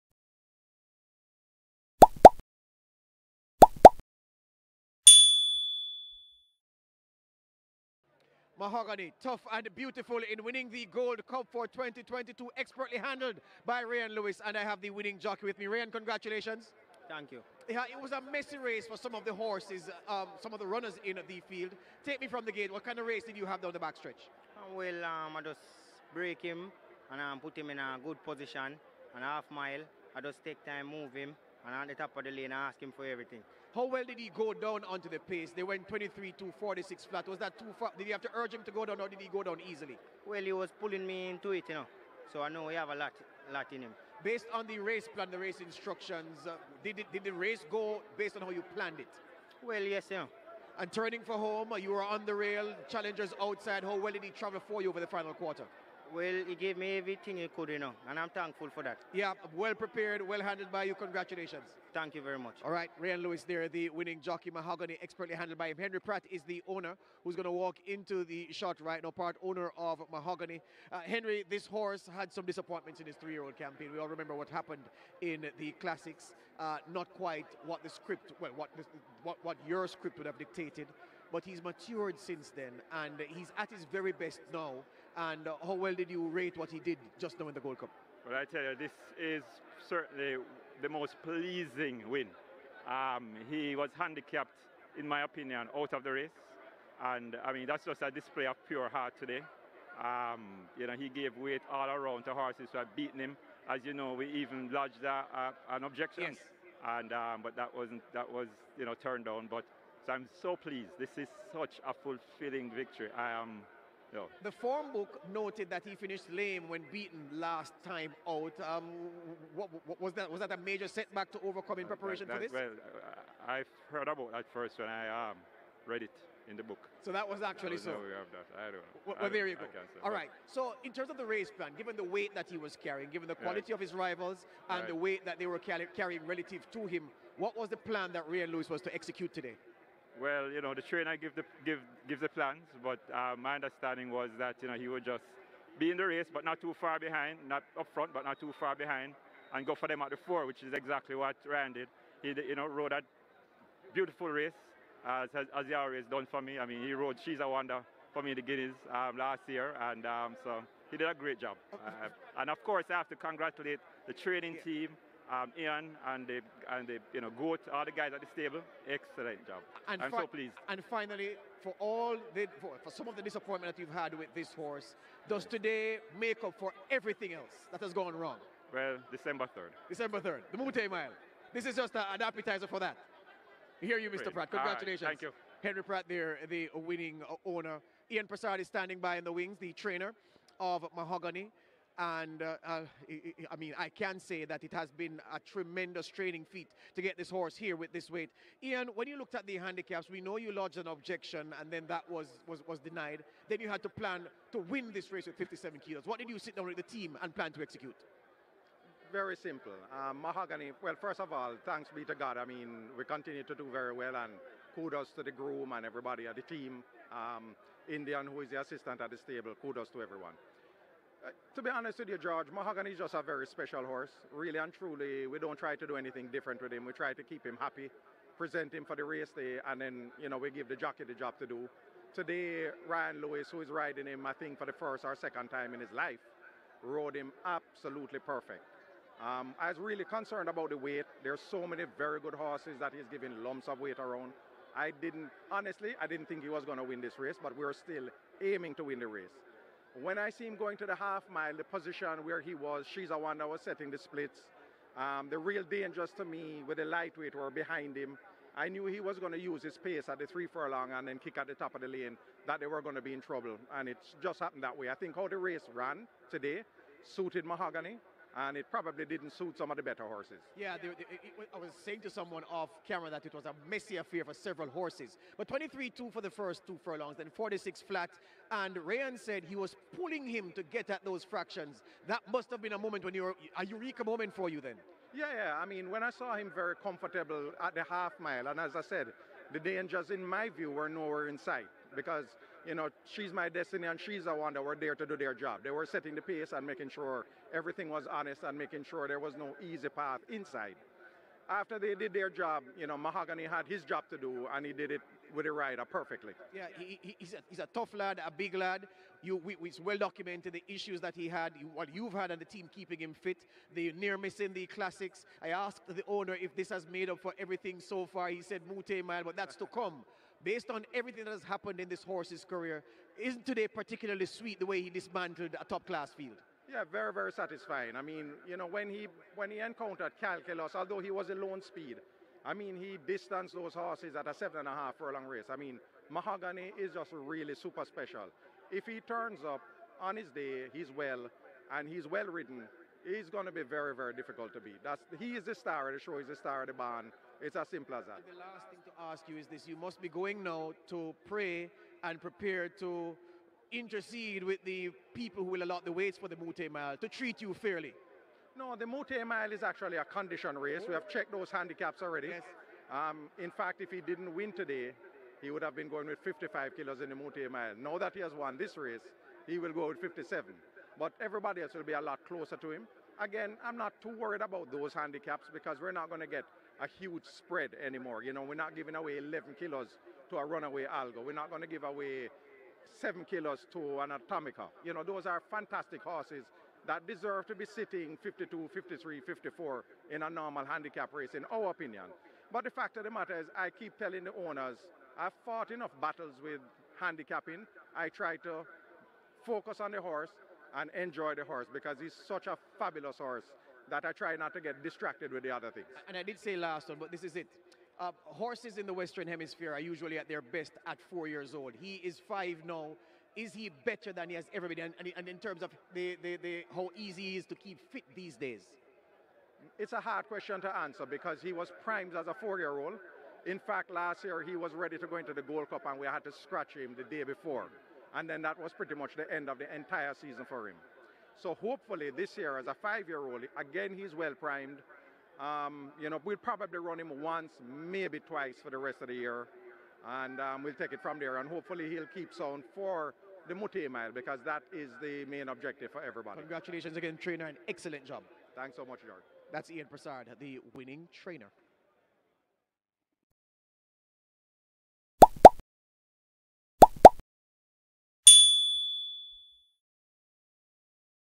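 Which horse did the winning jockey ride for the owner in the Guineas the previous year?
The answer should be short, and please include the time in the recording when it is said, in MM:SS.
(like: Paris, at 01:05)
She's a Wonder, at 02:37.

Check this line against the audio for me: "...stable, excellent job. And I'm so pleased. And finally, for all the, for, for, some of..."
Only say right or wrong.
right.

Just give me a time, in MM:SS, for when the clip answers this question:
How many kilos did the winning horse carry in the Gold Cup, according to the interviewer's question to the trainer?
03:25.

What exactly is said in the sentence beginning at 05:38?
If he turns up on his day, he's well, and he's well ridden, he's going to be very, very difficult to beat.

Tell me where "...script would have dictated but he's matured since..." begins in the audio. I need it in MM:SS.
01:19.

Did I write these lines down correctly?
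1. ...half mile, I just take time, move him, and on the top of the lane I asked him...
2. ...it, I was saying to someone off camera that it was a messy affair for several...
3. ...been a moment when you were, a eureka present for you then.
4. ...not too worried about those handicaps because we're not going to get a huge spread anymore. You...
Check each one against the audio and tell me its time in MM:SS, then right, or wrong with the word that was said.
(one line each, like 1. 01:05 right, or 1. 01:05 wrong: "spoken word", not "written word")
1. 00:29 right
2. 04:31 right
3. 04:42 wrong: "moment", not "present"
4. 06:13 right.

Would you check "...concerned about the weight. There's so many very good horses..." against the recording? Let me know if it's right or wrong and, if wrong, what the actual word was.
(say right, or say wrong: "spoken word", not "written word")
right.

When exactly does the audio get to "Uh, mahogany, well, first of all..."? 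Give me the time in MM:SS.
03:29.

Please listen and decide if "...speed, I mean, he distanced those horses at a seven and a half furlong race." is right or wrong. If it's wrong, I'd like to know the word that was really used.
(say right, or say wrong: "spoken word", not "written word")
right.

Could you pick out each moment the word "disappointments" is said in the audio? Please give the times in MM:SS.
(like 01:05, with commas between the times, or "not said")
01:12, 02:53.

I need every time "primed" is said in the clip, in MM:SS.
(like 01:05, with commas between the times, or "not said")
07:01, 07:14.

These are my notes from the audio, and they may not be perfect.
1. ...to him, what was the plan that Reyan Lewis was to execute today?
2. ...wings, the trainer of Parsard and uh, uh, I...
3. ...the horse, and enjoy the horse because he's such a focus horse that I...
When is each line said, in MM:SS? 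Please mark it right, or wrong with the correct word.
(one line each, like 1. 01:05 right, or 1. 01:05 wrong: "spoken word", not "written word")
1. 02:16 right
2. 03:09 wrong: "Mahogany", not "Parsard"
3. 06:39 wrong: "fabulous", not "focus".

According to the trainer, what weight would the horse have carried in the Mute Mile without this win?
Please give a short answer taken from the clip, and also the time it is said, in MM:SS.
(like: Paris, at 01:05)
55 kilos, at 06:06.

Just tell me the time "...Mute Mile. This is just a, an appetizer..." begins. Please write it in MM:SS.
03:00.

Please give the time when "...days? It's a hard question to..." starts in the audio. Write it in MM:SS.
06:58.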